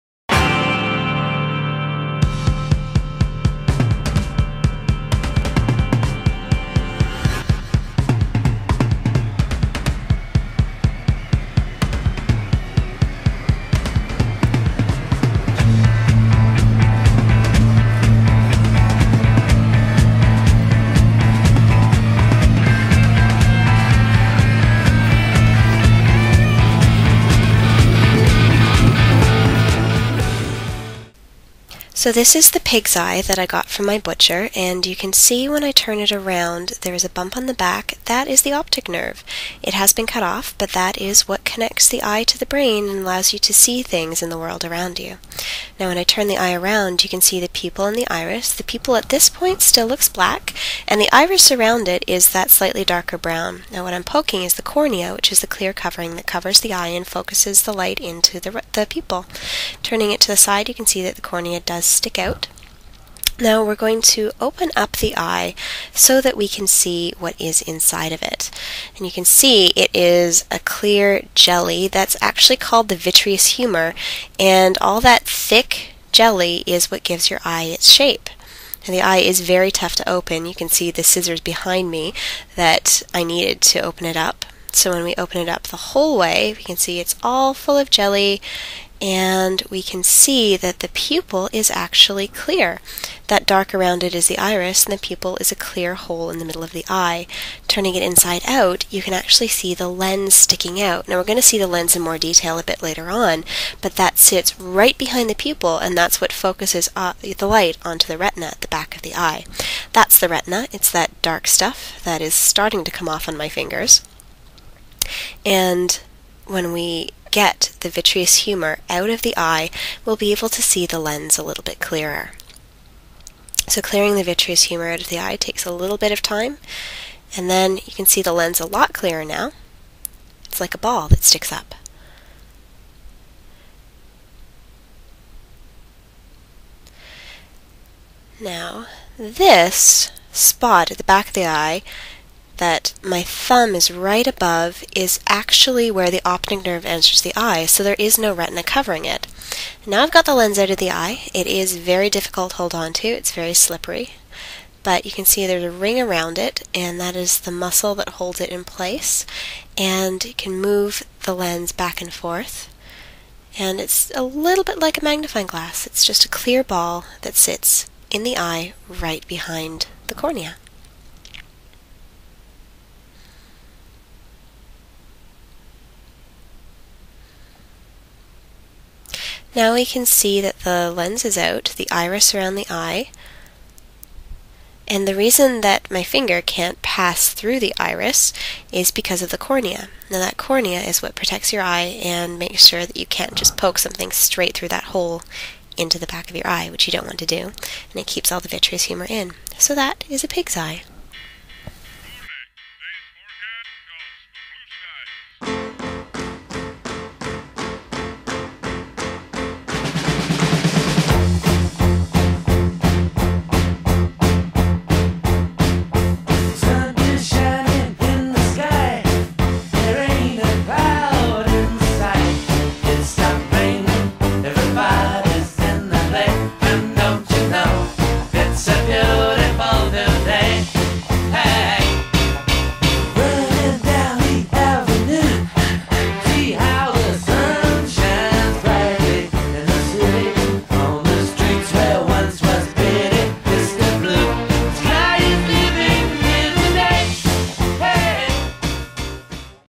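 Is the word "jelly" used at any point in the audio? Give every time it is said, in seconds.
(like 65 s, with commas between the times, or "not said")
71 s, 76 s, 87 s.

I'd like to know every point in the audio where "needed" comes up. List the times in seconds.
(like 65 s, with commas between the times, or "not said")
83 s.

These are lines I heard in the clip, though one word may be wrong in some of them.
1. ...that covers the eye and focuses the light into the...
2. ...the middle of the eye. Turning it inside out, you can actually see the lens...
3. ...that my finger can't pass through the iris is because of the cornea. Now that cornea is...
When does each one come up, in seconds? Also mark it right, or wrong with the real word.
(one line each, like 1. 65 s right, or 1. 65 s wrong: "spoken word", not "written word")
1. 56 s right
2. 96 s right
3. 185 s right.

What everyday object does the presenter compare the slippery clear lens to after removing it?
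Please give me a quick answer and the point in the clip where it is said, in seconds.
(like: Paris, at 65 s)
A magnifying glass, at 165 s.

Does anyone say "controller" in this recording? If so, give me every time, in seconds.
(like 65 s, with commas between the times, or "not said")
not said.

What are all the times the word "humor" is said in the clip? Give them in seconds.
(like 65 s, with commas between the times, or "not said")
73 s, 118 s, 124 s, 198 s.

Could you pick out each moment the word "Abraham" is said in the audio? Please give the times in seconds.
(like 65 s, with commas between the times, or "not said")
not said.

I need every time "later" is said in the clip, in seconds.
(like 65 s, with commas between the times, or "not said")
102 s.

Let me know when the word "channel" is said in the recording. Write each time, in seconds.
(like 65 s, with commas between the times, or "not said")
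not said.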